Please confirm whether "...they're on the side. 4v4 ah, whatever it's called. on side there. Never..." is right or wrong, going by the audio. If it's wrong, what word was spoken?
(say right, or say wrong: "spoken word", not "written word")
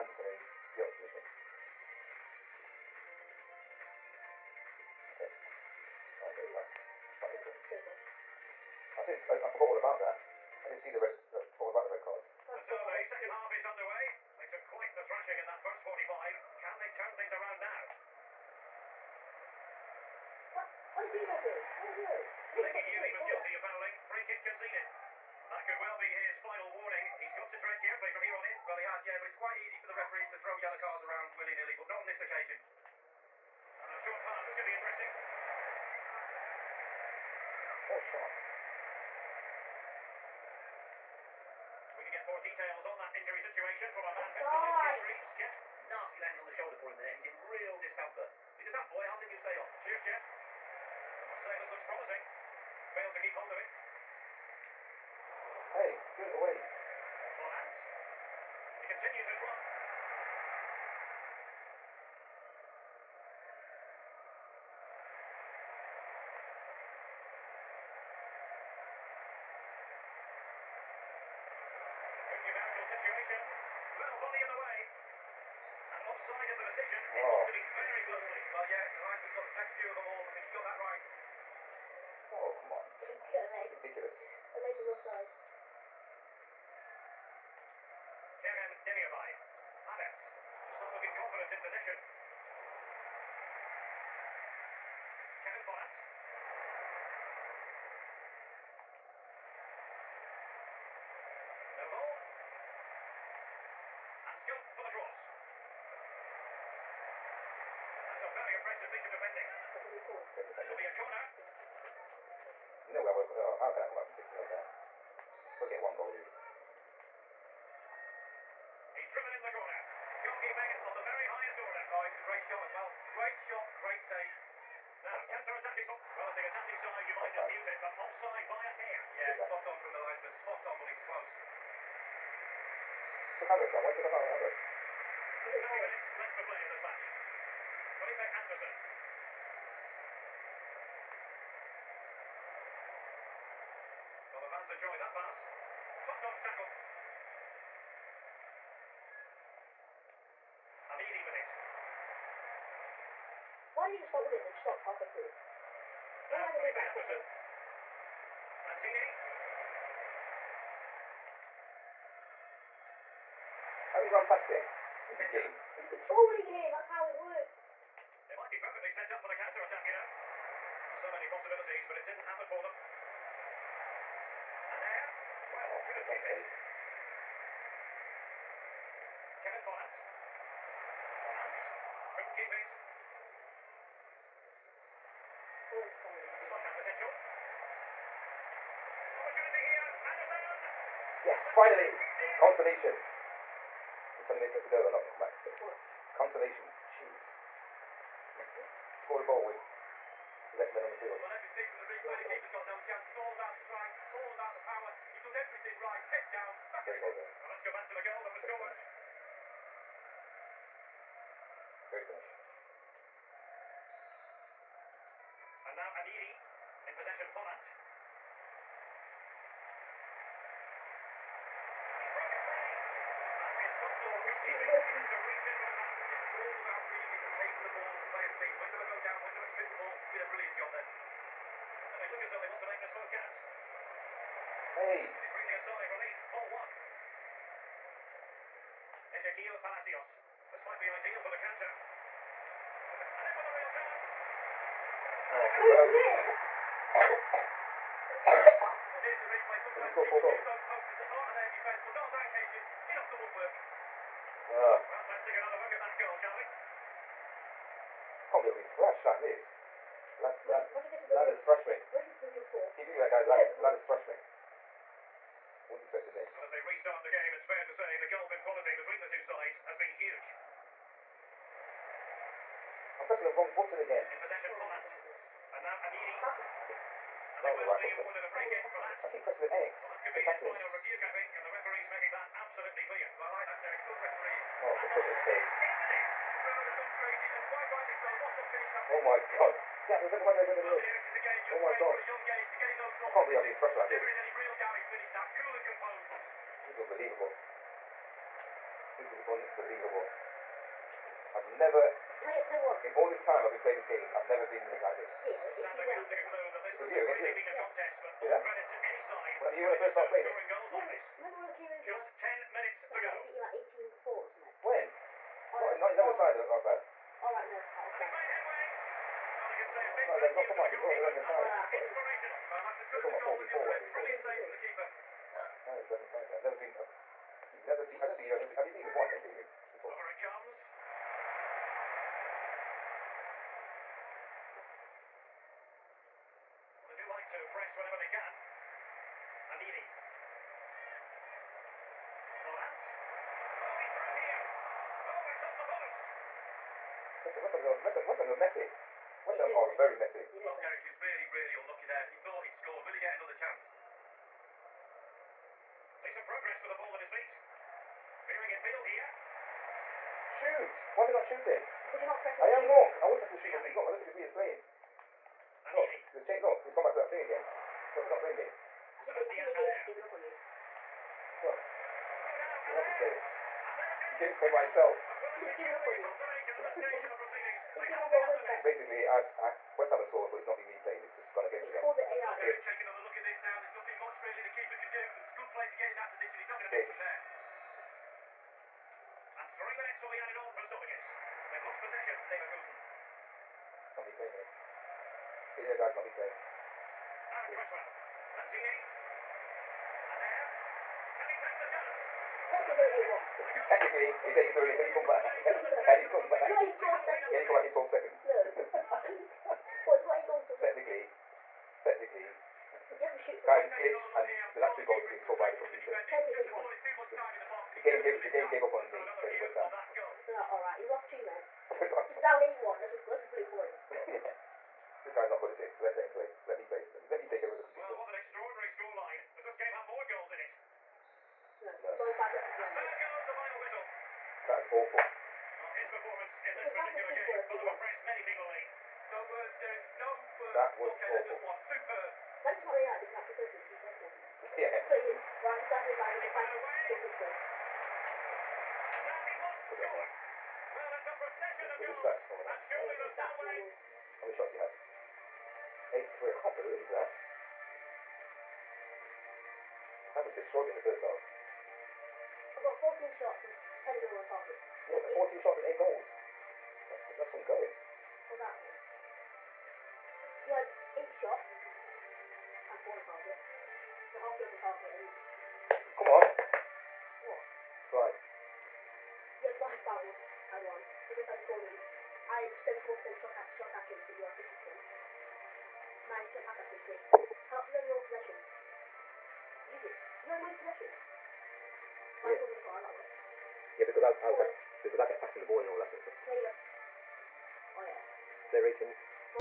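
right.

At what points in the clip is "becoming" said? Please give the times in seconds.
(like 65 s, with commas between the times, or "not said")
not said.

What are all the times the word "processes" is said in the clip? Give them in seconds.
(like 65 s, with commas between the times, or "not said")
not said.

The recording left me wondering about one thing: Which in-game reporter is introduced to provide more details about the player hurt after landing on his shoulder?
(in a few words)
Lucas Reeves.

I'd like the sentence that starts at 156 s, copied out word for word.
No uh, am I going to do Jefferson.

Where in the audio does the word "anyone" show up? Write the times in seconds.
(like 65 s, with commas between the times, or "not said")
422 s.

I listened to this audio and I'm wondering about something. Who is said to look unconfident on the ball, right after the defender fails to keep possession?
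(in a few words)
Kerem Demirbay.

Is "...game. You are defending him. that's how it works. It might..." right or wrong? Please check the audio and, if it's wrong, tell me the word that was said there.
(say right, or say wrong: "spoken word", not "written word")
wrong: "controlling", not "defending".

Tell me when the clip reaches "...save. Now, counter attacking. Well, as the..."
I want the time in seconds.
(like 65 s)
123 s.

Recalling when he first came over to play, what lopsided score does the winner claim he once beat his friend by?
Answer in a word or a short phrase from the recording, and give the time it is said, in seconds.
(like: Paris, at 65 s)
18-4, at 313 s.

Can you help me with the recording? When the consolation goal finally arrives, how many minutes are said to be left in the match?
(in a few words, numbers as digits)
20.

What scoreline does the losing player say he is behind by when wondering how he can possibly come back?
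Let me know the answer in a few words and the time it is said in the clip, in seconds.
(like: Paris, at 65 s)
6-0, at 114 s.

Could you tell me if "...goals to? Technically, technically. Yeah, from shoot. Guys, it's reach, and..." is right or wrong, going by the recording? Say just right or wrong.
wrong.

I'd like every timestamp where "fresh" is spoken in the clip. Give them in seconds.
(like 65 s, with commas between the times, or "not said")
258 s, 263 s, 293 s.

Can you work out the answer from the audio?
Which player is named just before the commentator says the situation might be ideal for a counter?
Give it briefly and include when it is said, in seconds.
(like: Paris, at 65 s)
Exequiel Palacios, at 239 s.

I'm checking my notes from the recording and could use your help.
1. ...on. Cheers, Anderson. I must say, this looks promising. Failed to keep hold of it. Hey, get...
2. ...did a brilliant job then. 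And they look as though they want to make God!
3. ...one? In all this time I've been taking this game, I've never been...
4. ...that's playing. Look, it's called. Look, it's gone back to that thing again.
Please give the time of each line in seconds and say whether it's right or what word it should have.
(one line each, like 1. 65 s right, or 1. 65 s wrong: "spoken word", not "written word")
1. 49 s wrong: "Geoff", not "Anderson"
2. 230 s wrong: "Hey", not "God"
3. 302 s wrong: "playing", not "taking"
4. 364 s wrong: "changed", not "called".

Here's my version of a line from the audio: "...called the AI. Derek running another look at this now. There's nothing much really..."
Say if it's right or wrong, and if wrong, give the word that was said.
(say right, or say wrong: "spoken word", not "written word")
wrong: "taking", not "running".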